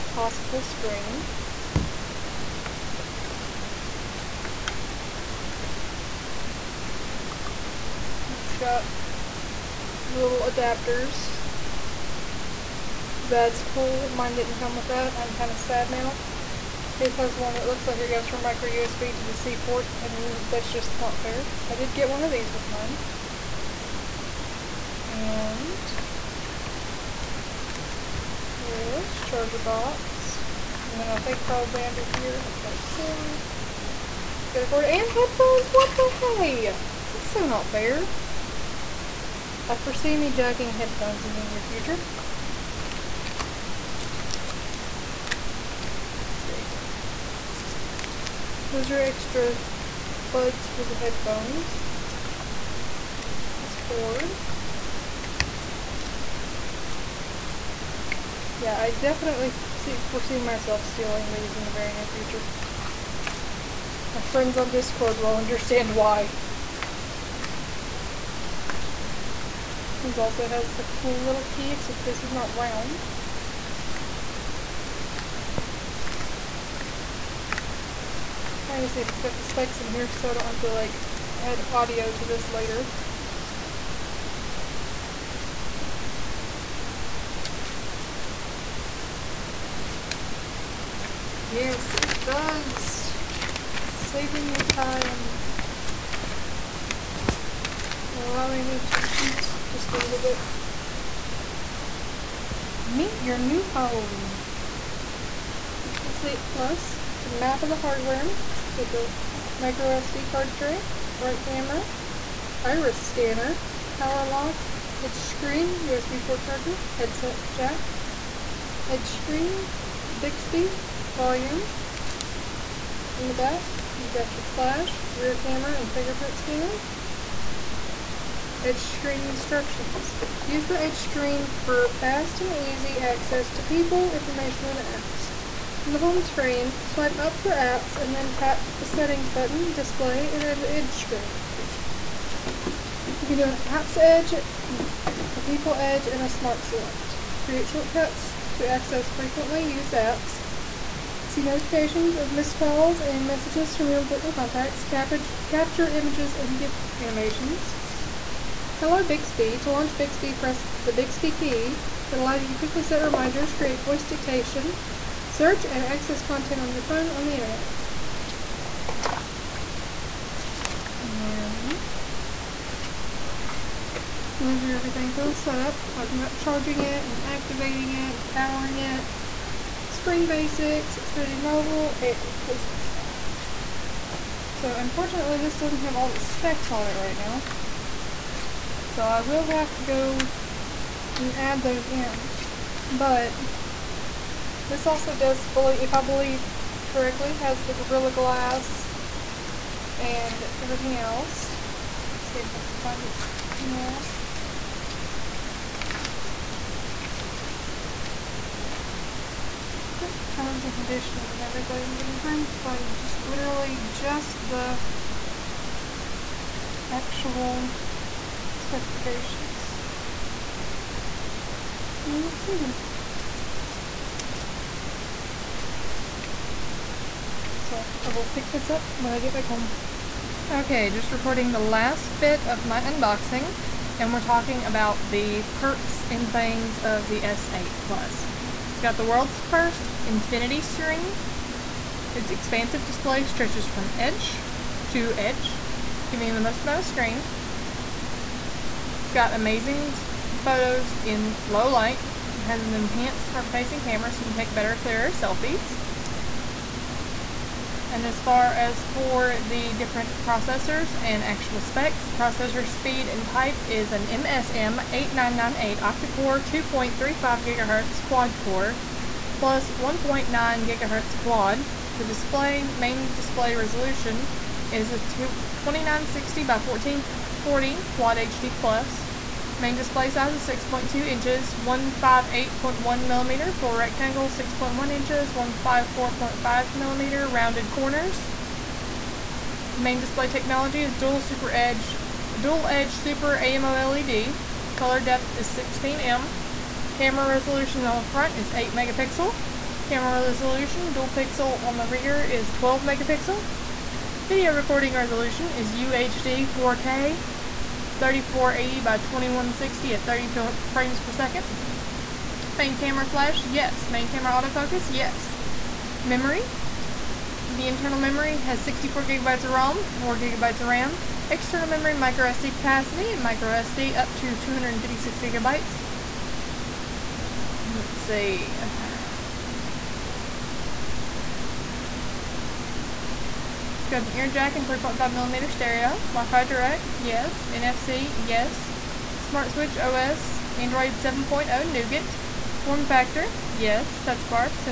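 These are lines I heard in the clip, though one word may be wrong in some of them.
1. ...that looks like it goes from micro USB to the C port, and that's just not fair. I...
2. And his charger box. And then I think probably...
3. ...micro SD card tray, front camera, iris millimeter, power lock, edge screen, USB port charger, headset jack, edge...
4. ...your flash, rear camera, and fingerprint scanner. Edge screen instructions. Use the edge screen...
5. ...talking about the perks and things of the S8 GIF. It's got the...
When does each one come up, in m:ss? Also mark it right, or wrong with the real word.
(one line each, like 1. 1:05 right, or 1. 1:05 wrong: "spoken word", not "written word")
1. 0:17 right
2. 0:25 right
3. 1:49 wrong: "scanner", not "millimeter"
4. 2:04 right
5. 3:54 wrong: "Plus", not "GIF".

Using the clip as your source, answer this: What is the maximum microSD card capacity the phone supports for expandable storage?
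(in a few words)
256 GB.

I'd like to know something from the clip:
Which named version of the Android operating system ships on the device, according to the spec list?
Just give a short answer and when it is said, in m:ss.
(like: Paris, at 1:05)
Android 7.0 Nougat, at 5:40.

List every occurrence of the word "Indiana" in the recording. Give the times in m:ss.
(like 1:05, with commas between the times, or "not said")
not said.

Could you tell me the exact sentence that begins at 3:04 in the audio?
So unfortunately this doesn't have all the specs on it right now.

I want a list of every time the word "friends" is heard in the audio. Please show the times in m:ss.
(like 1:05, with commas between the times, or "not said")
1:04.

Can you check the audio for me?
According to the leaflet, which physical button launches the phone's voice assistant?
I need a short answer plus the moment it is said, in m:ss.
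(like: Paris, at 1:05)
Bixby key, at 2:40.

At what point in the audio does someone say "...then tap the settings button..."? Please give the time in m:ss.
2:18.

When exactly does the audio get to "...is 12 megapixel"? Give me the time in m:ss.
5:02.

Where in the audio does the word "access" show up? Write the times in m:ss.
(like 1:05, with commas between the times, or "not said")
2:12, 2:28, 2:45.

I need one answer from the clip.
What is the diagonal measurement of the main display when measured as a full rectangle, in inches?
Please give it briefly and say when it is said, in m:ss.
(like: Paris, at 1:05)
6.2 inches, at 4:40.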